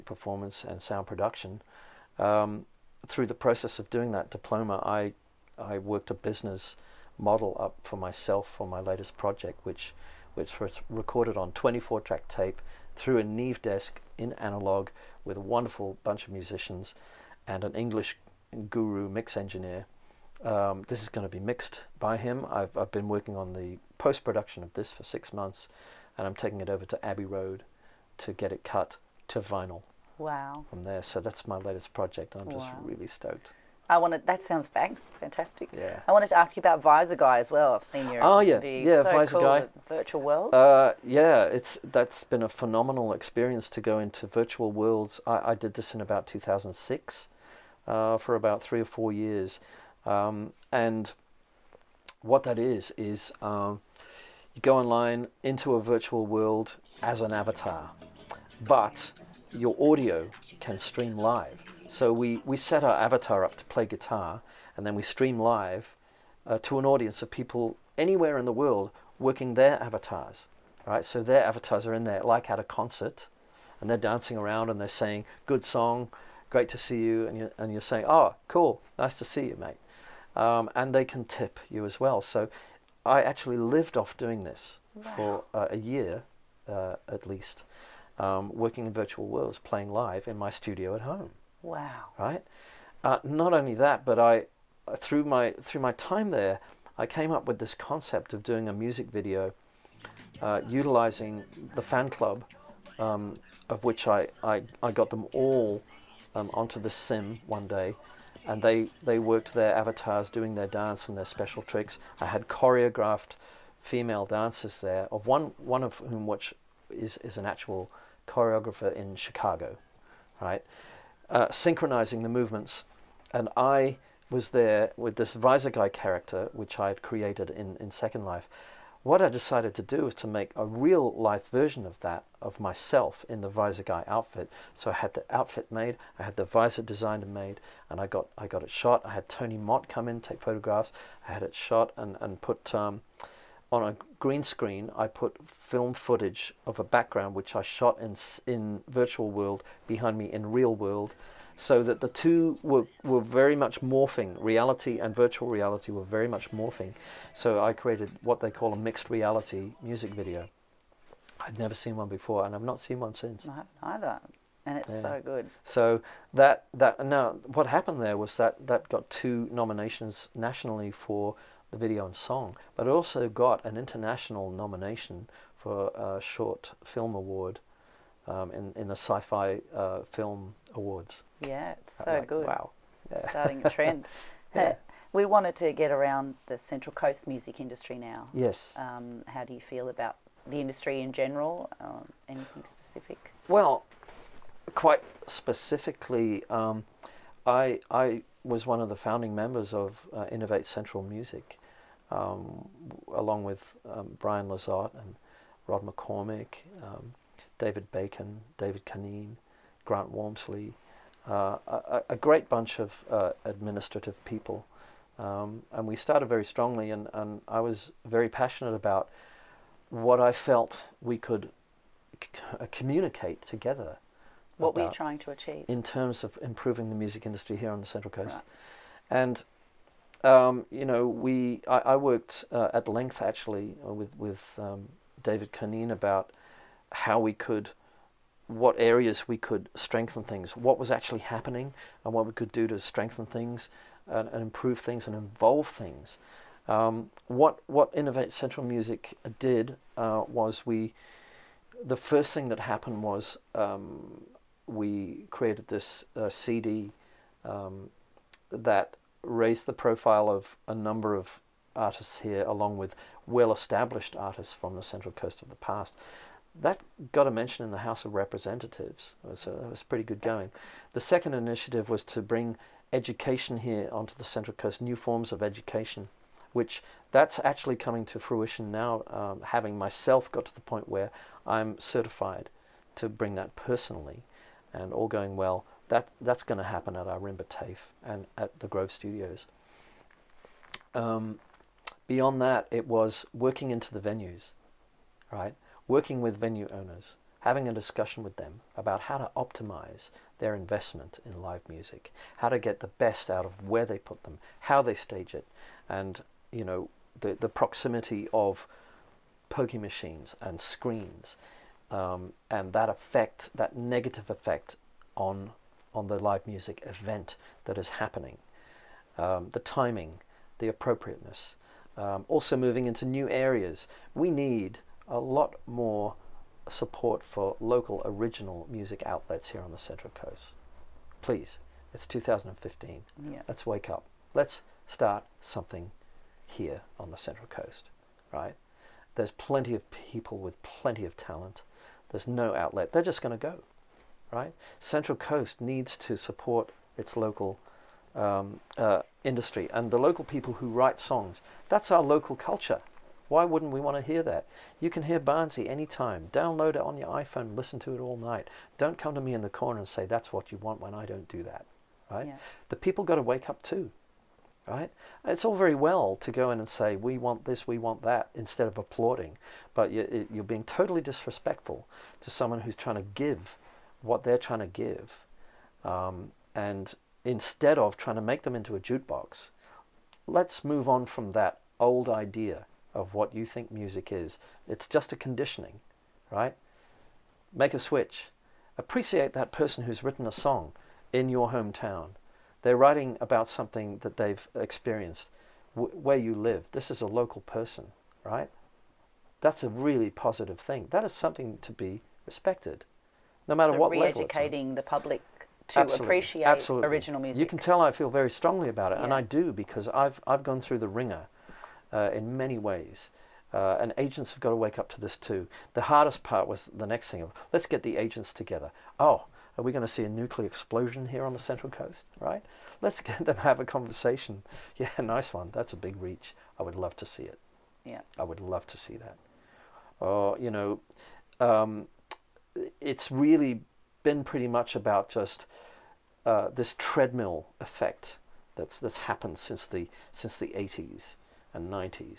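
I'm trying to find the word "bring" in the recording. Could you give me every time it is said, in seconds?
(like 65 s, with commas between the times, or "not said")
272 s, 283 s.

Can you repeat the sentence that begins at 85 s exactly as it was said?
for uh, a year uh, at least, um, working in virtual worlds, playing live in my studio at home.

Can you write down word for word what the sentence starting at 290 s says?
Um, beyond that, it was working into the venues, right?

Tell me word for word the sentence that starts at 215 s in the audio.
Um, and we started very strongly, and, and I was very passionate about what I felt we could uh, communicate together.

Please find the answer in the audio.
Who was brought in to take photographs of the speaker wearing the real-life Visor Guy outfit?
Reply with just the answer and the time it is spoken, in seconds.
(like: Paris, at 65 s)
Tony Mott, at 139 s.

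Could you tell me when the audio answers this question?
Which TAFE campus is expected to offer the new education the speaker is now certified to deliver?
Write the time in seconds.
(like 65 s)
287 s.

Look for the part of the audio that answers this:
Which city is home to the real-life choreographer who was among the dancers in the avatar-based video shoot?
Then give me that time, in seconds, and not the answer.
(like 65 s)
119 s.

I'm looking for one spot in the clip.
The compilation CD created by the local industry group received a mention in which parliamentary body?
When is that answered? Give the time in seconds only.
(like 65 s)
267 s.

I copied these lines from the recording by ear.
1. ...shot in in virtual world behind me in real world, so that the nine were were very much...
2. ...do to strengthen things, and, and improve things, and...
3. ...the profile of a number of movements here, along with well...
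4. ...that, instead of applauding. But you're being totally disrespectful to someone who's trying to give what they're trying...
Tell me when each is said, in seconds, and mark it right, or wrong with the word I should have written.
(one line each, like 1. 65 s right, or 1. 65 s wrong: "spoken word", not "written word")
1. 147 s wrong: "two", not "nine"
2. 242 s right
3. 259 s wrong: "artists", not "movements"
4. 368 s right.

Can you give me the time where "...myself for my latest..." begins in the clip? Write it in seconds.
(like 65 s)
7 s.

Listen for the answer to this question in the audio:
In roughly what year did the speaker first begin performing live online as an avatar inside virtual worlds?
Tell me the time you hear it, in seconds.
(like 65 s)
46 s.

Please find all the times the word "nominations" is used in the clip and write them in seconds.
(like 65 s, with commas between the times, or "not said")
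169 s, 174 s.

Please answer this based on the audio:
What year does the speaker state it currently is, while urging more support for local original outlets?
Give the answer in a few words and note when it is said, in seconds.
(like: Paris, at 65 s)
2015, at 332 s.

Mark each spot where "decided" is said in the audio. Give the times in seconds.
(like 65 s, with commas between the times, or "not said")
129 s.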